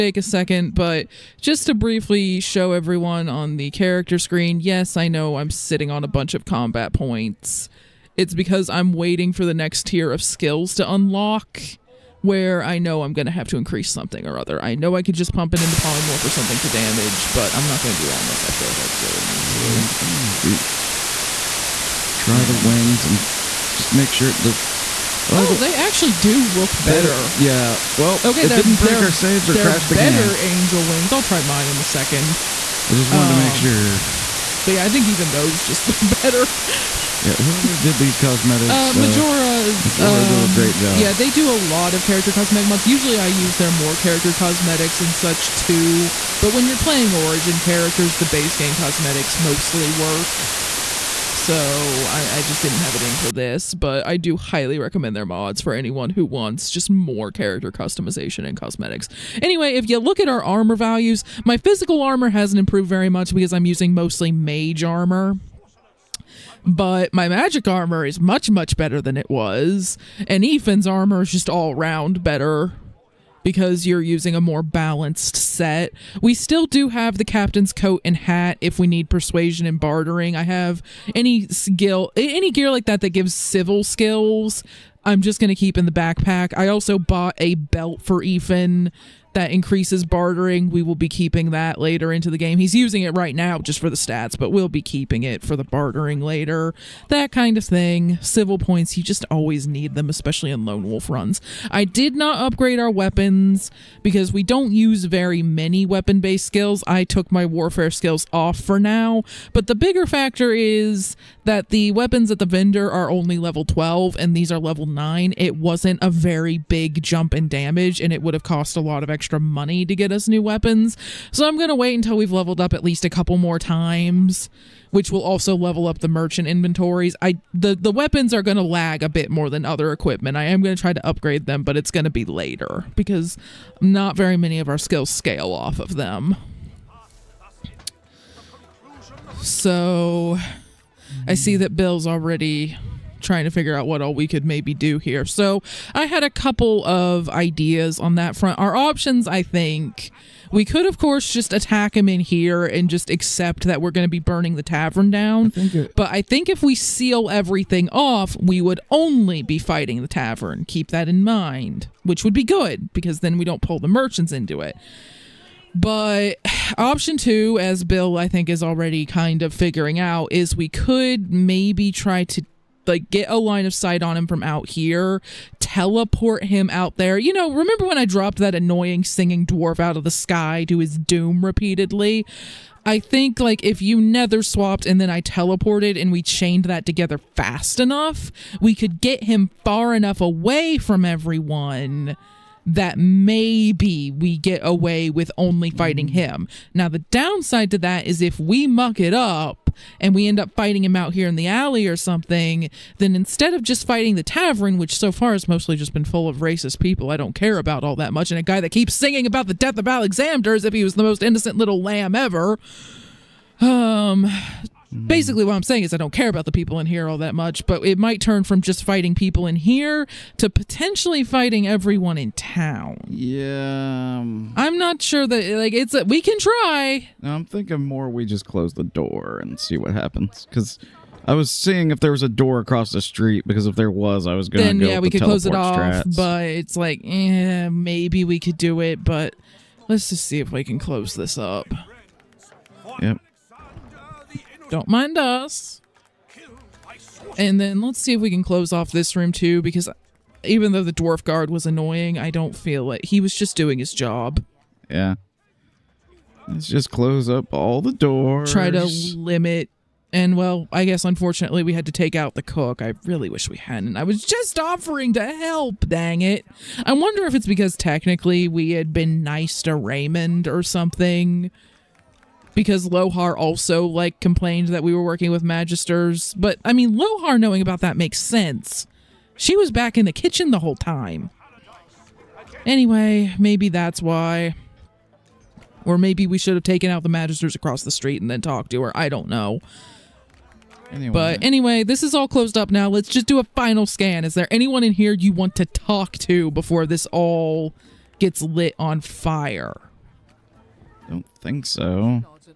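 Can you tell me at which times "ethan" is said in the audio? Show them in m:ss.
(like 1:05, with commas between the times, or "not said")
1:10, 1:28.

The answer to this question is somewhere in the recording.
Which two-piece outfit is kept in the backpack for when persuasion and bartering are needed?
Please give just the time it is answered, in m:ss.
1:17.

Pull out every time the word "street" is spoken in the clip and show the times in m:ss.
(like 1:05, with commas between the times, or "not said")
3:53, 4:47.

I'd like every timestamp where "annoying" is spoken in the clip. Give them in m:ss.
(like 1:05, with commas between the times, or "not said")
2:58, 4:11.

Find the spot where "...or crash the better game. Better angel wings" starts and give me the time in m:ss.
0:29.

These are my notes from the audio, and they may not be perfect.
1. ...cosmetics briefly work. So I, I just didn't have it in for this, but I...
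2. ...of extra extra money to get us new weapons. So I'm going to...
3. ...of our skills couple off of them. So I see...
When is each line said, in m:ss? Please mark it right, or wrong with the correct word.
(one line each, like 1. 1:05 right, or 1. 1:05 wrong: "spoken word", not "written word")
1. 0:48 wrong: "mostly", not "briefly"
2. 1:59 right
3. 2:14 wrong: "scale", not "couple".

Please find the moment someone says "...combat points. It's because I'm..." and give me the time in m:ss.
0:06.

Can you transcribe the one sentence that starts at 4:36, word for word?
But I mean, Lohar knowing about that makes sense.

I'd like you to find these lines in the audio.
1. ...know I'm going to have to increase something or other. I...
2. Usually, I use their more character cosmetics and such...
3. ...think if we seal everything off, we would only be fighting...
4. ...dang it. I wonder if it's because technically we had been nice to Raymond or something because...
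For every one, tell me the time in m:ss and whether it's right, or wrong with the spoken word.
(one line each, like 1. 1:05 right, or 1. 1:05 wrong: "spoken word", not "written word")
1. 0:12 right
2. 0:42 right
3. 2:36 right
4. 4:25 right.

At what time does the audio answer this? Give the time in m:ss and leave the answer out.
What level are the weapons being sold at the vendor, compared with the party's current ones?
1:53.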